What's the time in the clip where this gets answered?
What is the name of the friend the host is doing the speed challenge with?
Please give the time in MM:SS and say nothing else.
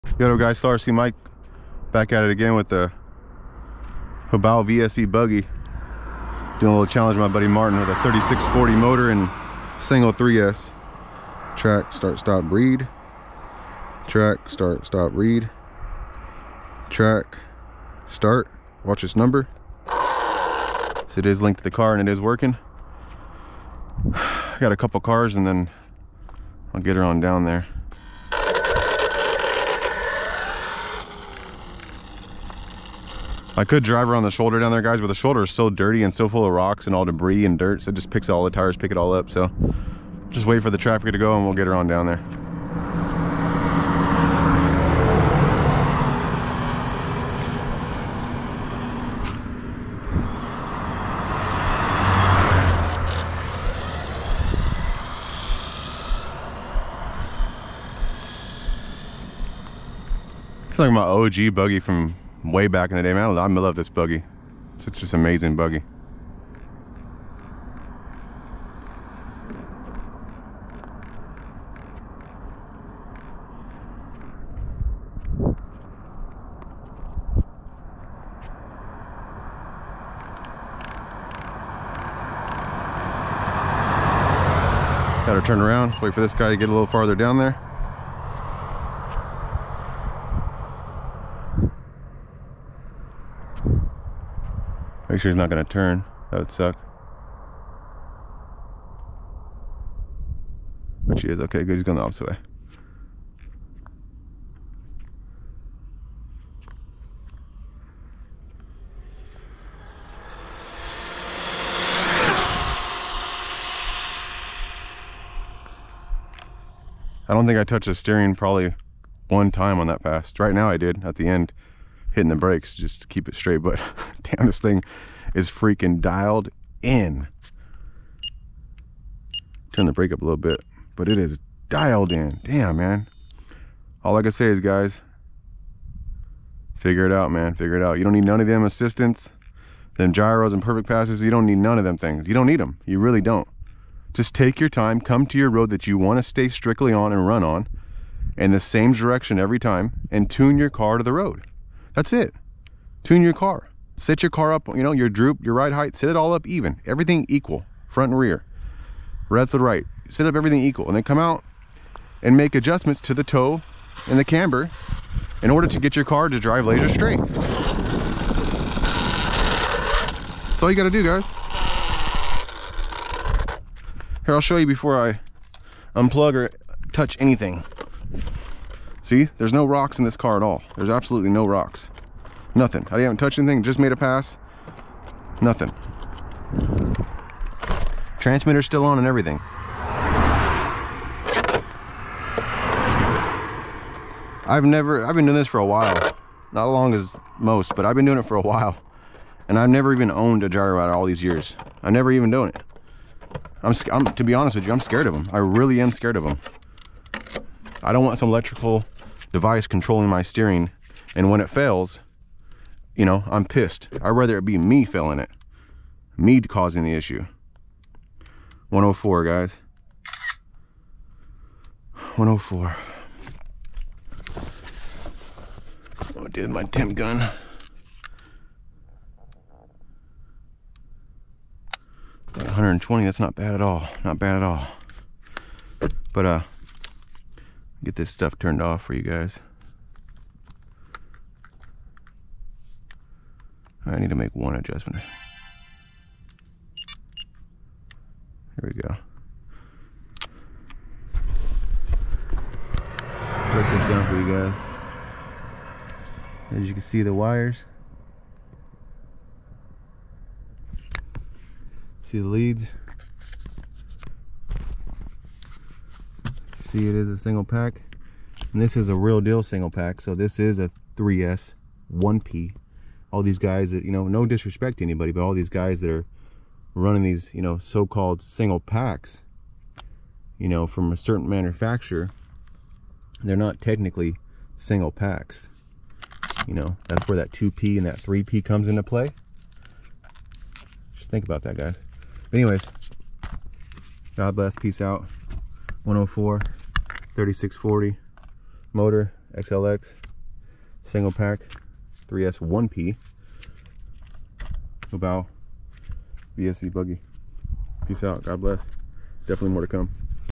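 00:07.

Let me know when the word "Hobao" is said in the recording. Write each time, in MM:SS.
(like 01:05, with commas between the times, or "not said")
00:04, 05:04.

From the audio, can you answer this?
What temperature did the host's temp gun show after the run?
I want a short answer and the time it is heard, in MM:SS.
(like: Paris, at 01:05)
120, at 03:52.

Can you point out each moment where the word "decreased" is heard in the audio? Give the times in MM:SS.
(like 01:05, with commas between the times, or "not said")
not said.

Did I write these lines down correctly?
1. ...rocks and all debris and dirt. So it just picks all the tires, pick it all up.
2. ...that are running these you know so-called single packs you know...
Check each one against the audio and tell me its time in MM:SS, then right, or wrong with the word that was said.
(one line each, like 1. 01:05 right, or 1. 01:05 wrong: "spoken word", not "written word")
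1. 00:36 right
2. 04:35 right.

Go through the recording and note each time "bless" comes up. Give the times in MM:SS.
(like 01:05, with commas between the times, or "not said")
04:54, 05:08.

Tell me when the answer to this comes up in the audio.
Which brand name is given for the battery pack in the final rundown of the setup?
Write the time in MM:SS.
04:59.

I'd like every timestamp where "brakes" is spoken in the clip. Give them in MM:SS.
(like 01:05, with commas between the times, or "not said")
02:02, 02:09.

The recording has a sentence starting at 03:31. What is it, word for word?
And when it fails, you know, I'm pissed.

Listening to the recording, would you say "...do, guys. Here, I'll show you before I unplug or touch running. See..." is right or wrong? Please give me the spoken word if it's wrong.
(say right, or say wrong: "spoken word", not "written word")
wrong: "anything", not "running".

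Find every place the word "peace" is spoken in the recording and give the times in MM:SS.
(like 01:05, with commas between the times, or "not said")
04:54, 05:07.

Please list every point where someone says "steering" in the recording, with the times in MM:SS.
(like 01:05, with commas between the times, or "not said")
01:57, 03:30.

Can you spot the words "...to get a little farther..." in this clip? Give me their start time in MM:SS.
01:26.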